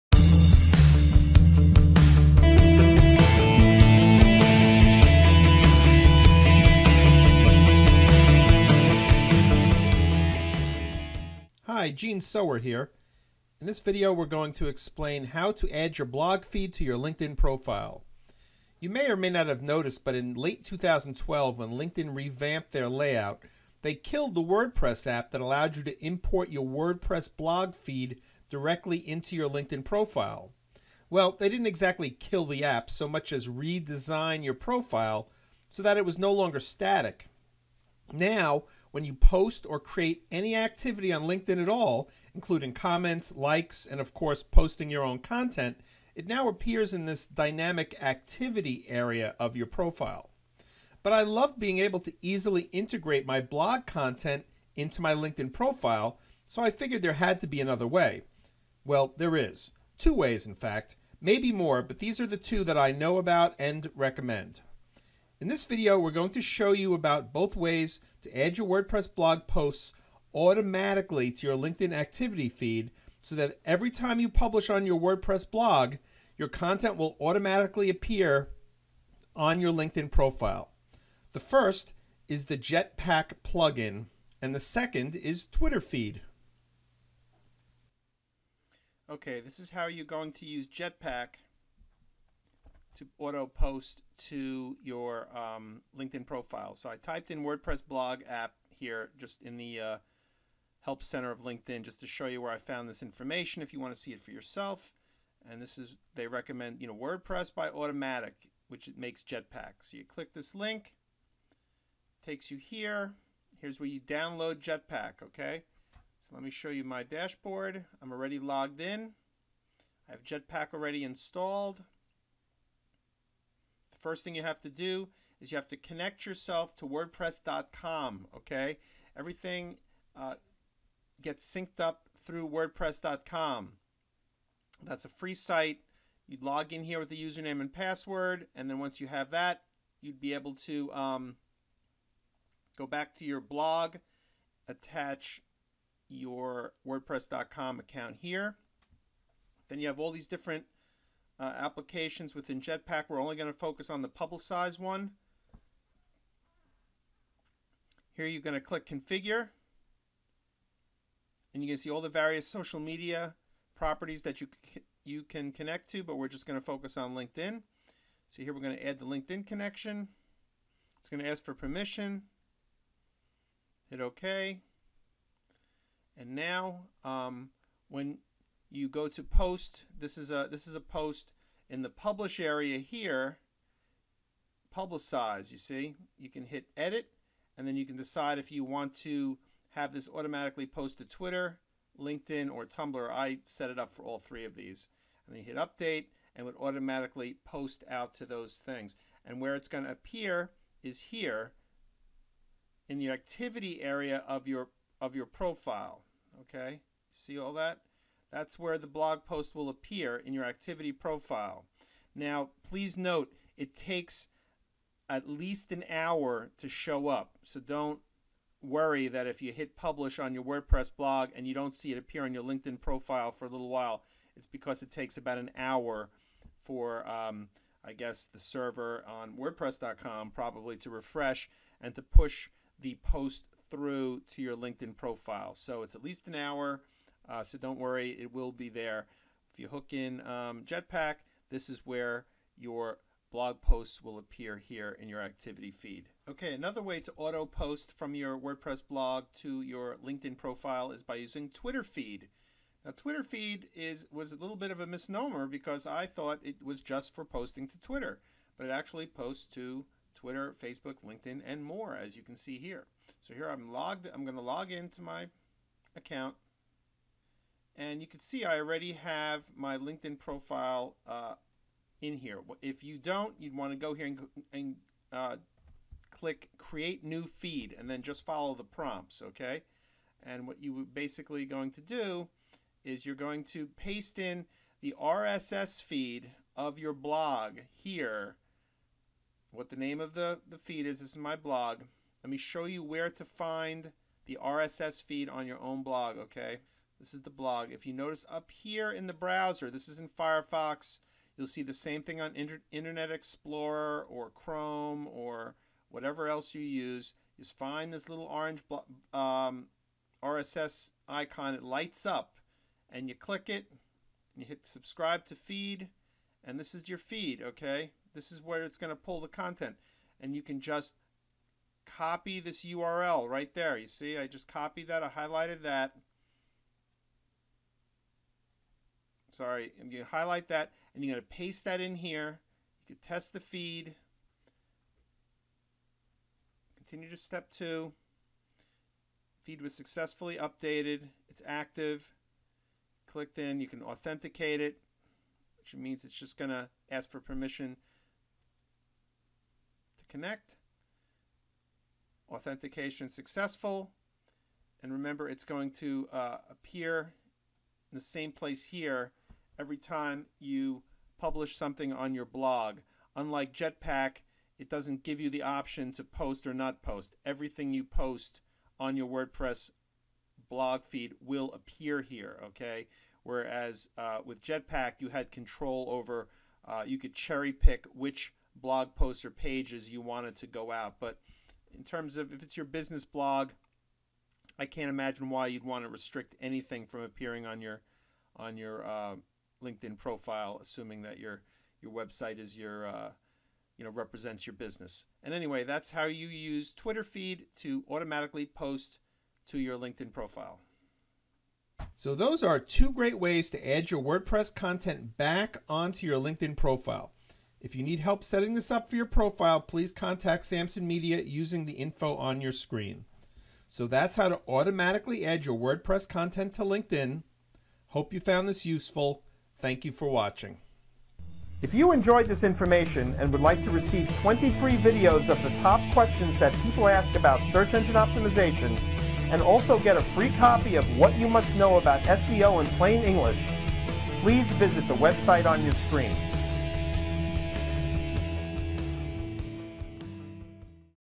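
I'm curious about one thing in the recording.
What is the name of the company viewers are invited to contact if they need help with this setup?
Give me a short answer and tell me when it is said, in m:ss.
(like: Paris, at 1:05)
Samson Media, at 6:50.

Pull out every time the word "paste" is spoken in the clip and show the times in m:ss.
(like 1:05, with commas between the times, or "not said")
4:43, 5:31.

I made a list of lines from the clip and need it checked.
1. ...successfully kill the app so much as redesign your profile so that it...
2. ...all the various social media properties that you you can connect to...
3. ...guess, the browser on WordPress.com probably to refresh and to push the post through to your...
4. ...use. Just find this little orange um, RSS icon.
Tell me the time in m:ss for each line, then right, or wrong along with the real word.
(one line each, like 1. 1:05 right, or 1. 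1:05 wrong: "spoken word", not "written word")
1. 0:31 wrong: "exactly", not "successfully"
2. 2:41 right
3. 3:47 wrong: "server", not "browser"
4. 5:06 right.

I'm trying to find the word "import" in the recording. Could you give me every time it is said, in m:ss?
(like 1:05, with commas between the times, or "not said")
0:26.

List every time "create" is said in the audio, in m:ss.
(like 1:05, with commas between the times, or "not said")
0:39, 4:36.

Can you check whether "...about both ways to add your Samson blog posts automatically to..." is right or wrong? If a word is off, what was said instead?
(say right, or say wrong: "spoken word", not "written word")
wrong: "WordPress", not "Samson".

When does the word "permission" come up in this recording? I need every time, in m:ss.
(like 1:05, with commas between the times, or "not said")
2:51, 5:47.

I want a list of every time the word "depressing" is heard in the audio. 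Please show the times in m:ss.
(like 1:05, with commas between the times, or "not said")
not said.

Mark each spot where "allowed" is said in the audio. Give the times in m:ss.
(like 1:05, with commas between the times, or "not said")
0:25.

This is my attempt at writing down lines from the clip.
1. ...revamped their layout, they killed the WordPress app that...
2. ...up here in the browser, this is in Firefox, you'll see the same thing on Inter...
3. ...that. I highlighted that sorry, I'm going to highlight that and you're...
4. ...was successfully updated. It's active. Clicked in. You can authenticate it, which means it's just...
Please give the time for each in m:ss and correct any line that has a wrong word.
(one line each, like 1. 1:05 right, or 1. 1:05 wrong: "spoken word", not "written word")
1. 0:22 right
2. 4:58 right
3. 5:24 right
4. 5:39 right.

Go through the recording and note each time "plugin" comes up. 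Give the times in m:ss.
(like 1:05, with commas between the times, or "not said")
1:23.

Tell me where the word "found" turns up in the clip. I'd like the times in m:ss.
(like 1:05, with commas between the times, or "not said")
1:42, 6:58.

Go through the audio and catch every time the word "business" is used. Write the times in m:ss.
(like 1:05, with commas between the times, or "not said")
6:22, 6:34.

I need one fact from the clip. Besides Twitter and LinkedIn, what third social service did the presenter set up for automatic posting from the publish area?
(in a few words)
Tumblr.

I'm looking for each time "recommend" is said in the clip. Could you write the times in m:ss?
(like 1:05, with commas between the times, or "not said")
1:03, 1:46.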